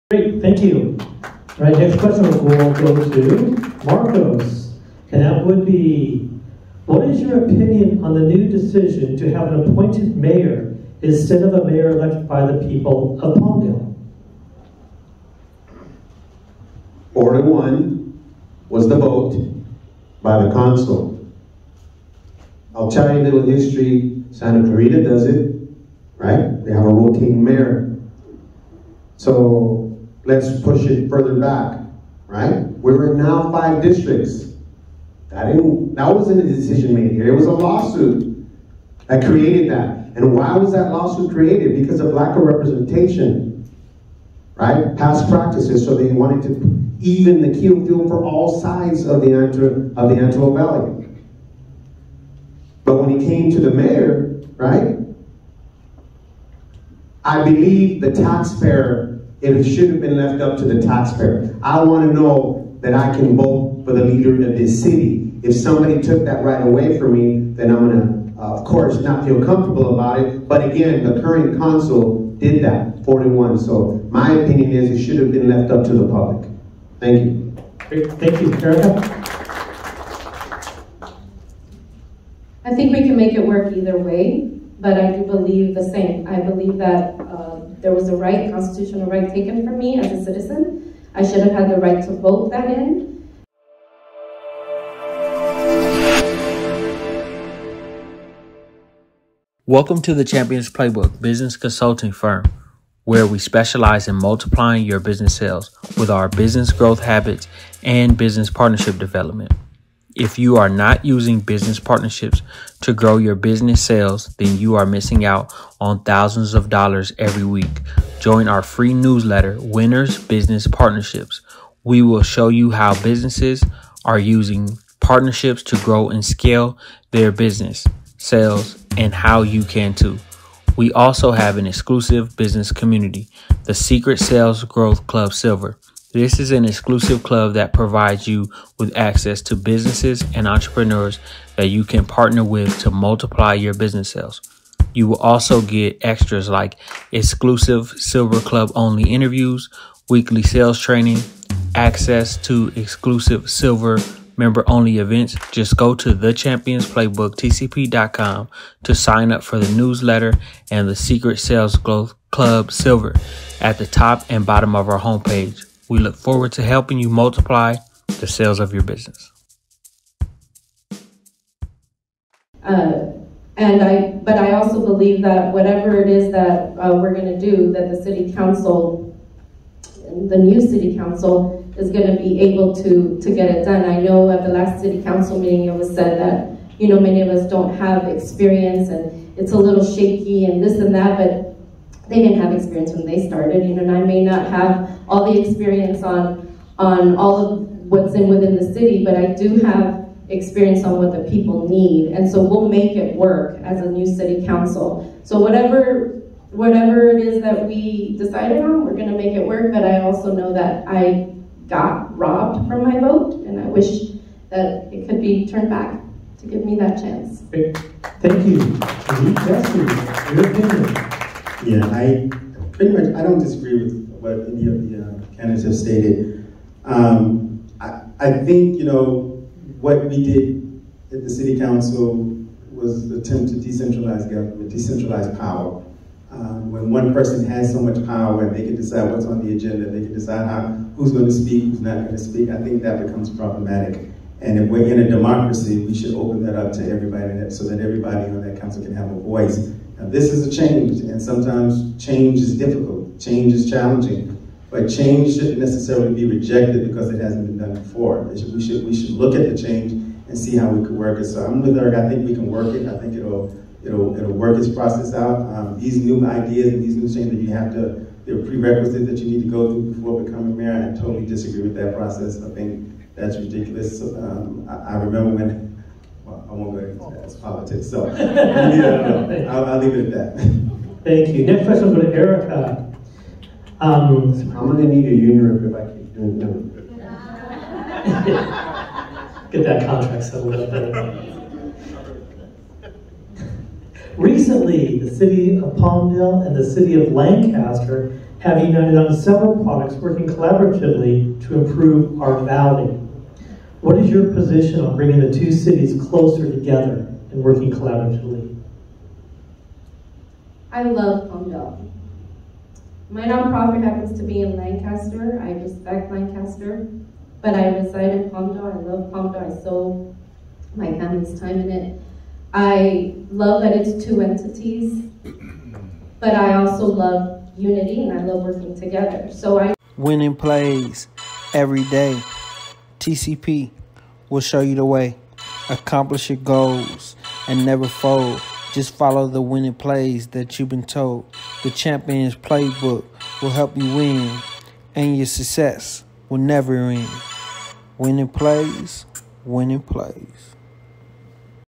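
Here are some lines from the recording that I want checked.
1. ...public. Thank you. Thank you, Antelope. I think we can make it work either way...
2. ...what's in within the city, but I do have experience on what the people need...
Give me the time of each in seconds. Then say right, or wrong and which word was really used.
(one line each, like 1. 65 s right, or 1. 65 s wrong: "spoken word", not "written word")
1. 76 s wrong: "Erica", not "Antelope"
2. 197 s right.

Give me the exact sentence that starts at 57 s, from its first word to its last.
I believe the taxpayer it should have been left up to the taxpayer.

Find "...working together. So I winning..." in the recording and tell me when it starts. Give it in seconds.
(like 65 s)
328 s.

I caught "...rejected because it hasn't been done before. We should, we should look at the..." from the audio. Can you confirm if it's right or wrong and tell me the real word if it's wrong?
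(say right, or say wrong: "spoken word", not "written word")
right.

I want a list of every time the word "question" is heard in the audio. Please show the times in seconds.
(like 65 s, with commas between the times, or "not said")
2 s, 281 s.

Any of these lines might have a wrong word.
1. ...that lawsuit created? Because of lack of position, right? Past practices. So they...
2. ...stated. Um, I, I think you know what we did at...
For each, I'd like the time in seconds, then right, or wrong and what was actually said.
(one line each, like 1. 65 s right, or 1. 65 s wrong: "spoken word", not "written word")
1. 40 s wrong: "representation", not "position"
2. 225 s right.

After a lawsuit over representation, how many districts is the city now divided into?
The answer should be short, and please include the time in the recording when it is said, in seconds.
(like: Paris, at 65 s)
5, at 33 s.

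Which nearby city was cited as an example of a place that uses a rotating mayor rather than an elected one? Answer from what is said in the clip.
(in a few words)
Santa Clarita.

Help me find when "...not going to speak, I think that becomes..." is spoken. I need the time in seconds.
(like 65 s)
241 s.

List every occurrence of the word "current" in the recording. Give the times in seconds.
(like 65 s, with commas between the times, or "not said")
71 s.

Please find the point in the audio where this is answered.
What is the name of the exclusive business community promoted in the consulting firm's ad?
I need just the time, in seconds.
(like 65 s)
133 s.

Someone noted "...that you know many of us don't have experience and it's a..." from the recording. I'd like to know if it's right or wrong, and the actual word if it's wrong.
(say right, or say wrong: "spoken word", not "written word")
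right.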